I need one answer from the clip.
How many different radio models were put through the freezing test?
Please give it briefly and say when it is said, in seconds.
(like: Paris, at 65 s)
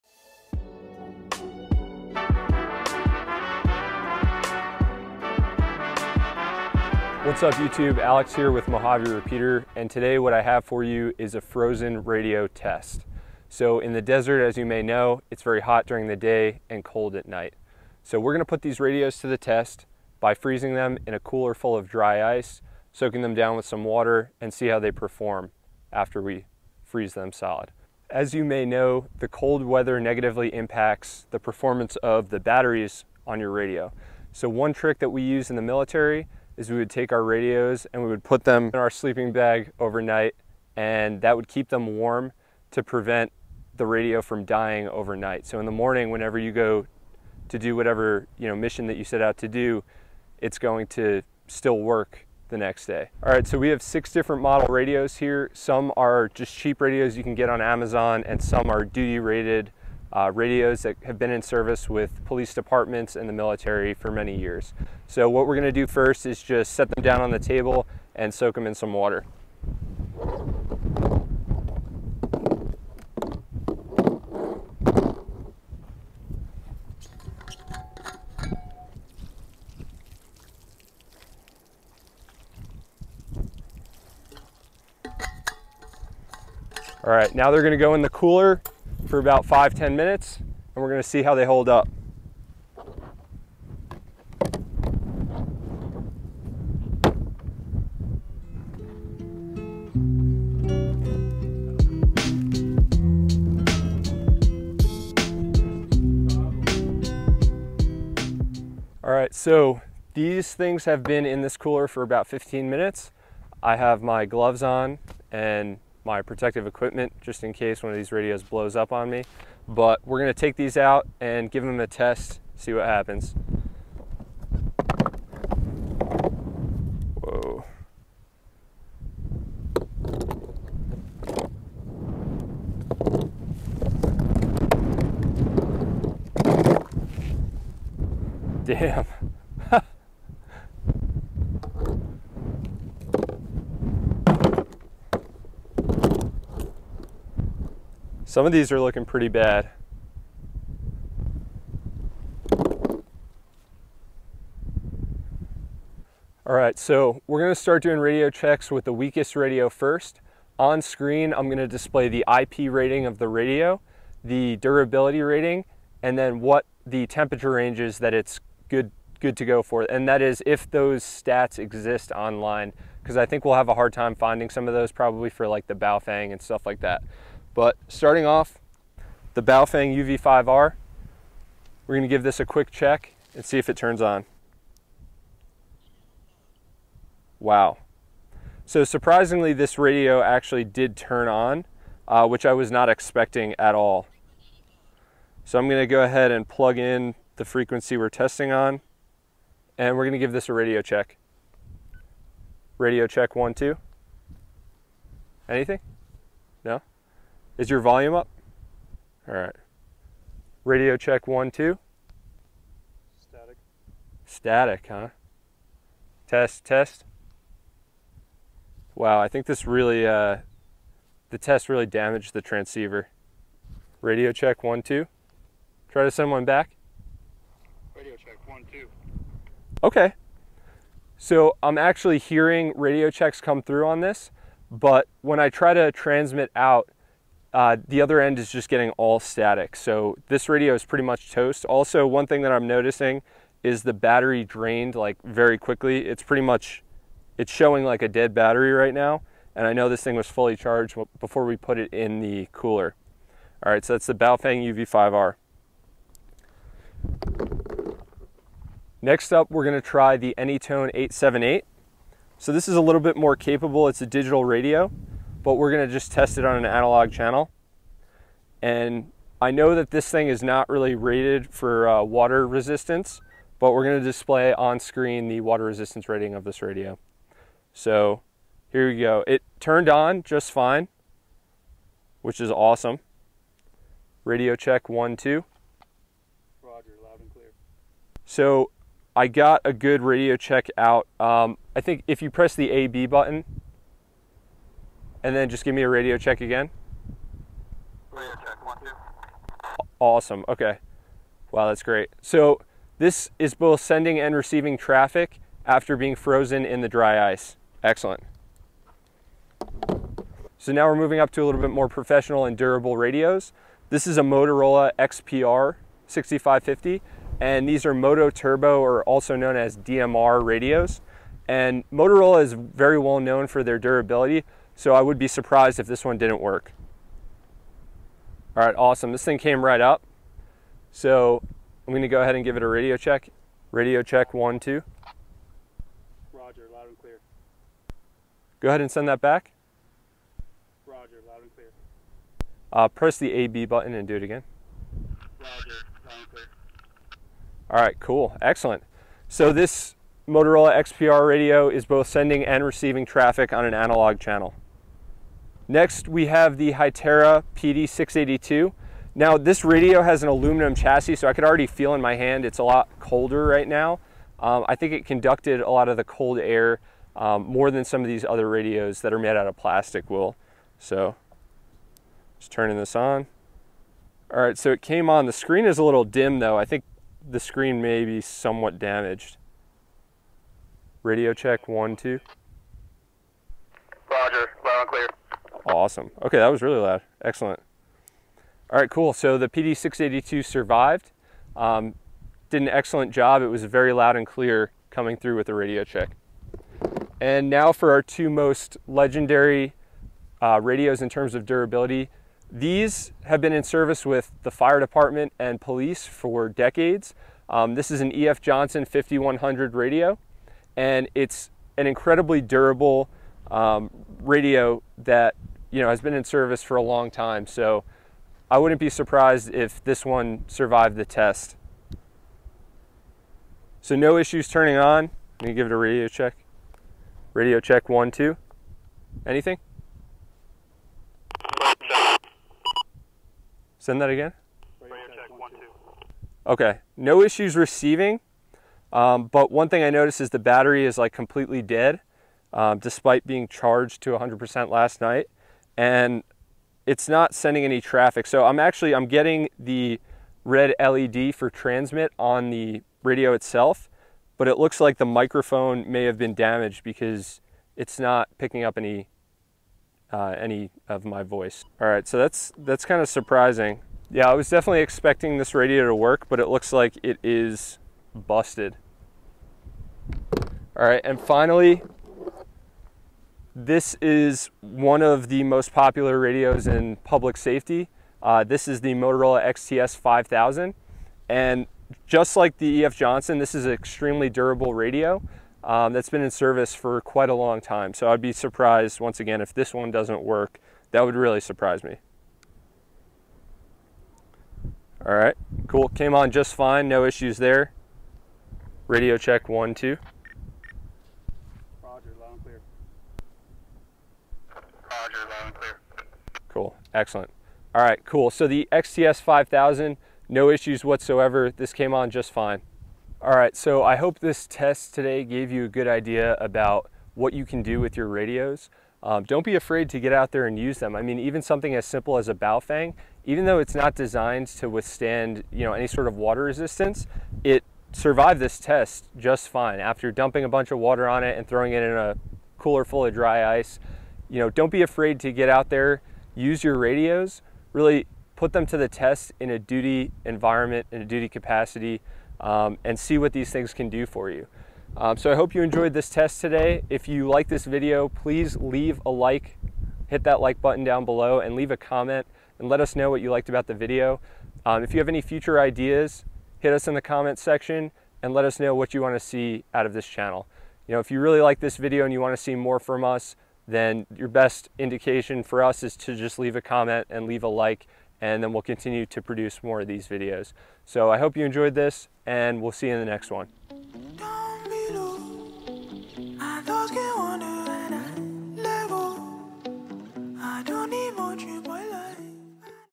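6, at 53 s.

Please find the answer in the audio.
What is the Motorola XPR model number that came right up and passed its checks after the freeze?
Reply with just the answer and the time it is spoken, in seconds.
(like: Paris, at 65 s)
XPR 6550, at 314 s.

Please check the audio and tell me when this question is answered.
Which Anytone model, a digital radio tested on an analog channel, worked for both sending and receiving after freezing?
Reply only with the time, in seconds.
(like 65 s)
260 s.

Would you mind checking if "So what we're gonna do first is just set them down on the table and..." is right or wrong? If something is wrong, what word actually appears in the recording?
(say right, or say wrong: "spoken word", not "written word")
right.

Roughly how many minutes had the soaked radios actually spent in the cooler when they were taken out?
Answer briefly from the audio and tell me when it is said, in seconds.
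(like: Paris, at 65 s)
15, at 112 s.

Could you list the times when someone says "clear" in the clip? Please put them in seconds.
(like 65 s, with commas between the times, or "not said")
287 s, 336 s, 341 s, 346 s, 384 s, 394 s.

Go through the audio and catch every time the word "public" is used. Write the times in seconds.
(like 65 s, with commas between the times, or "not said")
476 s.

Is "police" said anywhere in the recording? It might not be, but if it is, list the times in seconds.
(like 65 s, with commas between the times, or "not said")
62 s, 405 s.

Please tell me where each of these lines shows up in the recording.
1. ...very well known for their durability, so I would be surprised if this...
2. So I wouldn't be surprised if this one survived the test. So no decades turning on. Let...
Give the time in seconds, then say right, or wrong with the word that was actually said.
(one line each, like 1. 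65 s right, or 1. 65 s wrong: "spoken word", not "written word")
1. 322 s right
2. 417 s wrong: "issues", not "decades".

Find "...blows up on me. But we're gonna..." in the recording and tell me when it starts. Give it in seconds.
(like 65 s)
118 s.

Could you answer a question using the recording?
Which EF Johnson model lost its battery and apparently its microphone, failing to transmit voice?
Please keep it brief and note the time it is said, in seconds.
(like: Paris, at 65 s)
EF Johnson 5100, at 408 s.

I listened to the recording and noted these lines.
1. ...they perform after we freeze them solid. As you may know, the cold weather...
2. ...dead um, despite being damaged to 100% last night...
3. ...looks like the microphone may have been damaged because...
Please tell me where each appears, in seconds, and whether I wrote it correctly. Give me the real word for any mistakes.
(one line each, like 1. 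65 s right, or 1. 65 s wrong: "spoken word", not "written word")
1. 24 s right
2. 441 s wrong: "charged", not "damaged"
3. 454 s right.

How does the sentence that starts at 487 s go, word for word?
So I'd be surprised, once again, if this one doesn't work.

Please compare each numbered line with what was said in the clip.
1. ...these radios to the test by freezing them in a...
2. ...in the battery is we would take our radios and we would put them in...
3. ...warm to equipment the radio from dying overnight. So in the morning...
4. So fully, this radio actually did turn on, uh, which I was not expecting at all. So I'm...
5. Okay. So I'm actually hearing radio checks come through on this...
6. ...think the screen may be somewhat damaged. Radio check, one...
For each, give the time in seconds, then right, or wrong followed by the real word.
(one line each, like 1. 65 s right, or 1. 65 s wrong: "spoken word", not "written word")
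1. 18 s right
2. 35 s wrong: "military", not "battery"
3. 41 s wrong: "prevent", not "equipment"
4. 188 s wrong: "surprisingly", not "fully"
5. 229 s right
6. 376 s right.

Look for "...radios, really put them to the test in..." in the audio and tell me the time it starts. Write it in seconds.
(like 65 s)
536 s.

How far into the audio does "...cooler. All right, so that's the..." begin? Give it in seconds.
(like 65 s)
252 s.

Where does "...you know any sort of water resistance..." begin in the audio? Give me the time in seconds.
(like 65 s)
525 s.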